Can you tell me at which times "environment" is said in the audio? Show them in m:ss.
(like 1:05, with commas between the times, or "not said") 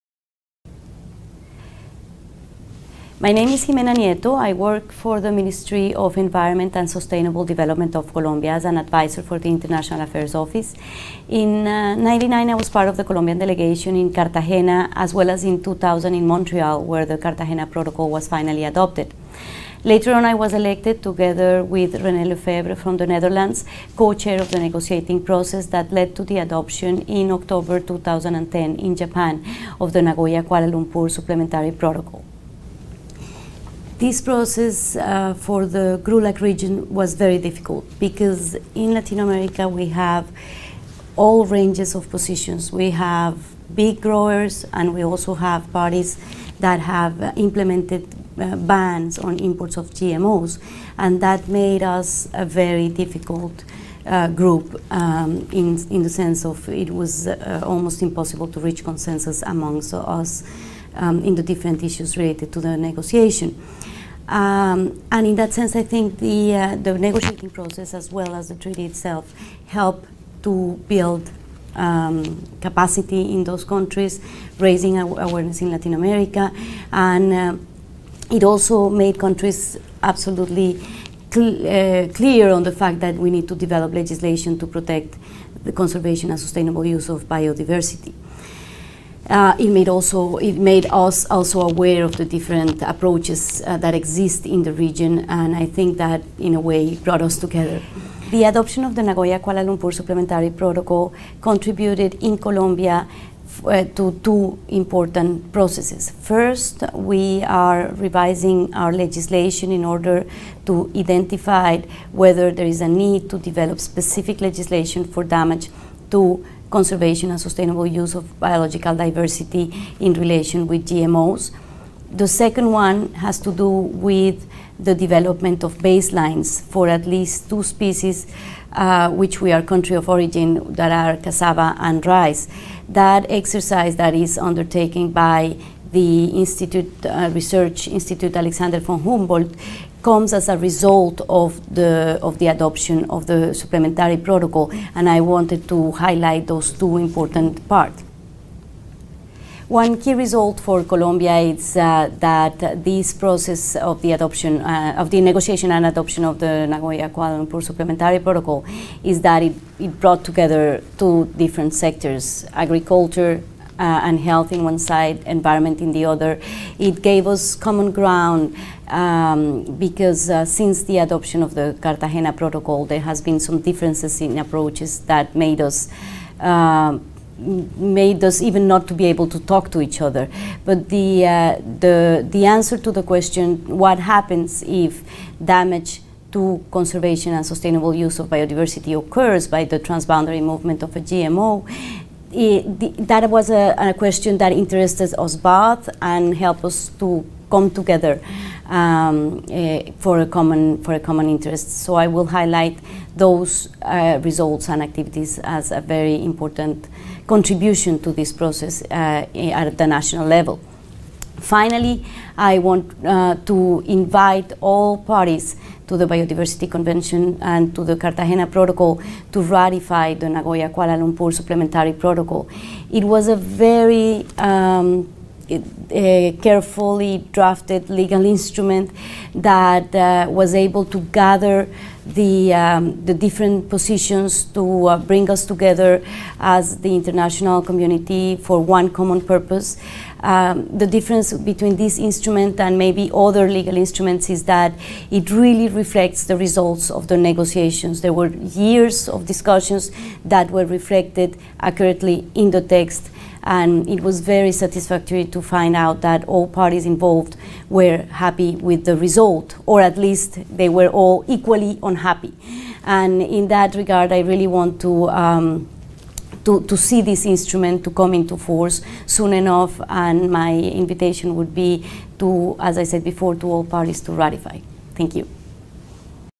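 0:06, 2:45.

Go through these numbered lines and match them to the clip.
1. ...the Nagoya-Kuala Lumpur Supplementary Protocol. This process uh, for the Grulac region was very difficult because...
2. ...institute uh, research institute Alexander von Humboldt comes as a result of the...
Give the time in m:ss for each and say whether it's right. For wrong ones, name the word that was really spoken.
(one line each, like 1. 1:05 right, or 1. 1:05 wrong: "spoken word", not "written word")
1. 0:29 right
2. 2:16 right.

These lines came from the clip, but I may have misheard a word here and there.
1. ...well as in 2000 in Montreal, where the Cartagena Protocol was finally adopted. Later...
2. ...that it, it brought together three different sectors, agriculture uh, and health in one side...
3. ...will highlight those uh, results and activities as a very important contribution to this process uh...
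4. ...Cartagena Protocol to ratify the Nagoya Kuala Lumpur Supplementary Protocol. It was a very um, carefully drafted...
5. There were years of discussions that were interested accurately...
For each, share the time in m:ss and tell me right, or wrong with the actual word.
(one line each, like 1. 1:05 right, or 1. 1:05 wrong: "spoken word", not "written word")
1. 0:15 right
2. 2:39 wrong: "two", not "three"
3. 3:22 right
4. 3:37 right
5. 4:08 wrong: "reflected", not "interested".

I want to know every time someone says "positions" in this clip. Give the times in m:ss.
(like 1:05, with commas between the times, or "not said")
0:42, 3:53.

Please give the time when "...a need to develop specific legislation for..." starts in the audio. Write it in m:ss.
1:52.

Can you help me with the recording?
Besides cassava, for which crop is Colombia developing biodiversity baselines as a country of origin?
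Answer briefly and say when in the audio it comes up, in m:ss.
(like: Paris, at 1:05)
rice, at 2:12.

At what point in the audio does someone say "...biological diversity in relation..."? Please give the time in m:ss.
1:58.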